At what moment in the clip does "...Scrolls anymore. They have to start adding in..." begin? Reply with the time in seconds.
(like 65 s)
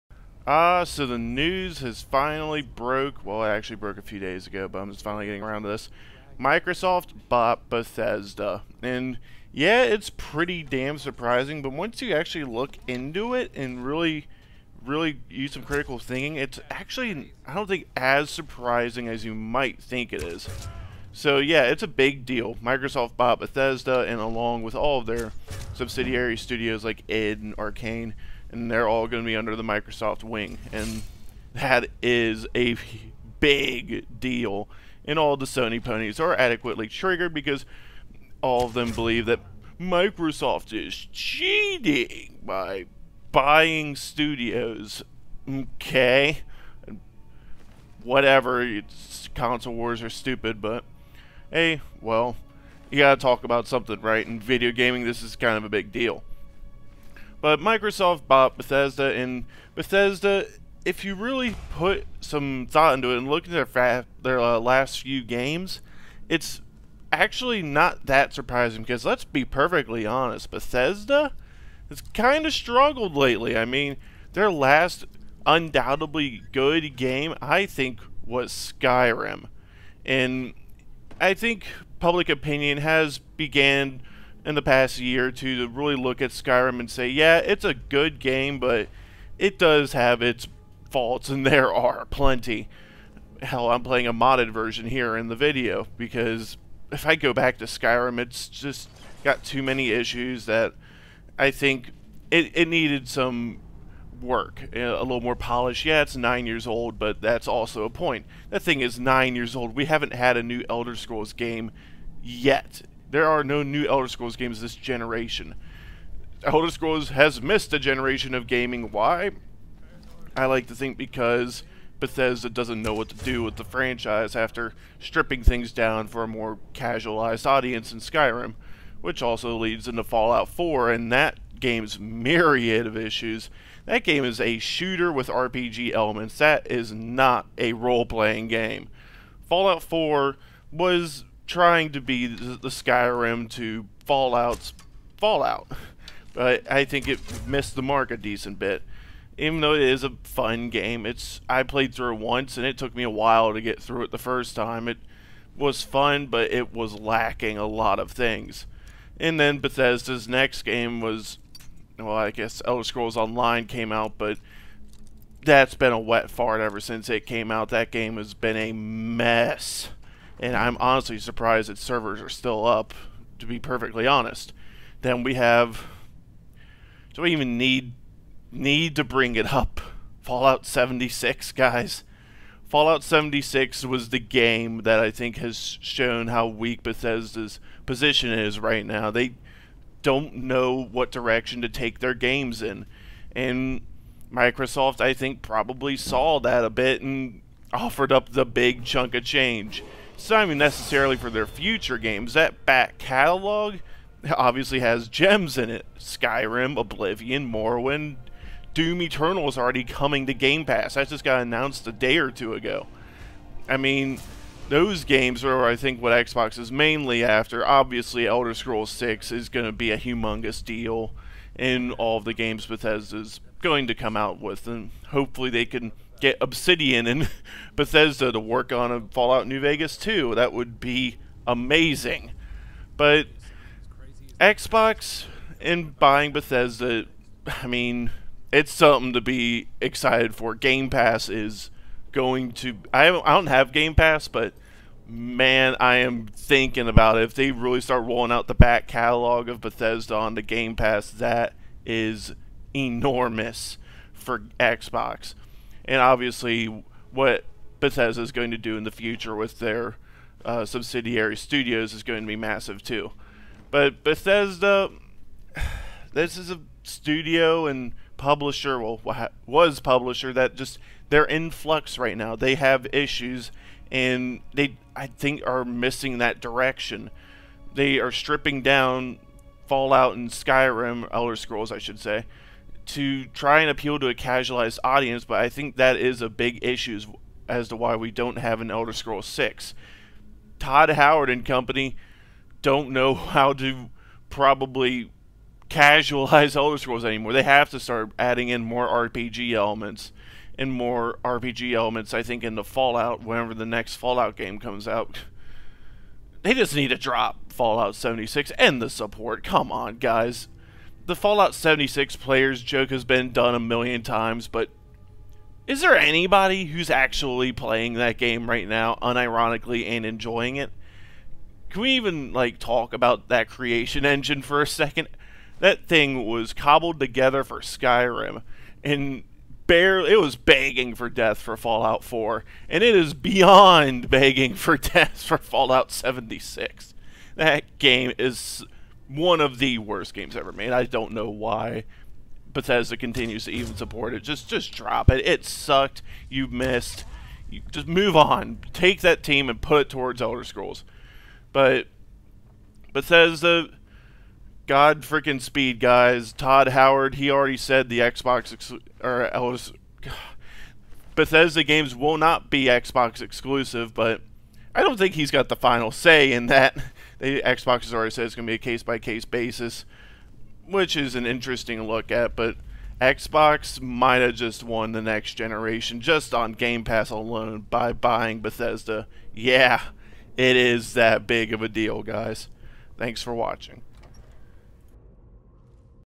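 296 s.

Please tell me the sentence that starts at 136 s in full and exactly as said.
That is not a role playing game.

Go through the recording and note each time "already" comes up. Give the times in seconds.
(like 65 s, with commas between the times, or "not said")
209 s, 357 s, 367 s.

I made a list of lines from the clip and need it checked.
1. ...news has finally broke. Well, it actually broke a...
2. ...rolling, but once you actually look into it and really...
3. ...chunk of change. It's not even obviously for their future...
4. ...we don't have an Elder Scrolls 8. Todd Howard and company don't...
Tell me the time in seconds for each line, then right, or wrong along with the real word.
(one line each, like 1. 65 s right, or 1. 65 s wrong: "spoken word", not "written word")
1. 1 s right
2. 10 s wrong: "surprising", not "rolling"
3. 198 s wrong: "necessarily", not "obviously"
4. 287 s wrong: "6", not "8".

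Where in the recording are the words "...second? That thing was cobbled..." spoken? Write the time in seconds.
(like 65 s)
324 s.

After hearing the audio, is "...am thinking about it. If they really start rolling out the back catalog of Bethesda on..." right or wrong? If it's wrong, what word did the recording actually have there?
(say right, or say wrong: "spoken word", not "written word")
right.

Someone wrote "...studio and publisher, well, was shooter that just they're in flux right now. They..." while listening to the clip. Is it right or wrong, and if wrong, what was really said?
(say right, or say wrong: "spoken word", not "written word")
wrong: "publisher", not "shooter".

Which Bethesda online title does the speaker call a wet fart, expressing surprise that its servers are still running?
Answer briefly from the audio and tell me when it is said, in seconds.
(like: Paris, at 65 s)
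Elder Scrolls Online, at 162 s.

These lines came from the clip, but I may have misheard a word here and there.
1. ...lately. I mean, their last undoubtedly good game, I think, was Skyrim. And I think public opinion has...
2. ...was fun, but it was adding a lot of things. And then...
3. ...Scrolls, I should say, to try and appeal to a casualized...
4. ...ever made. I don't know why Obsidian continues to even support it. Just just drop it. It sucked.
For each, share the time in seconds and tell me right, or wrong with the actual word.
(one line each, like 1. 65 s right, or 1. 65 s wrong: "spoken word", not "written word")
1. 73 s right
2. 155 s wrong: "lacking", not "adding"
3. 281 s right
4. 340 s wrong: "Bethesda", not "Obsidian".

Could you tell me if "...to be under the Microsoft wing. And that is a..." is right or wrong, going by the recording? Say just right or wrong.
right.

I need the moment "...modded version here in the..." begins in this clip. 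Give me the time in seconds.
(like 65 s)
94 s.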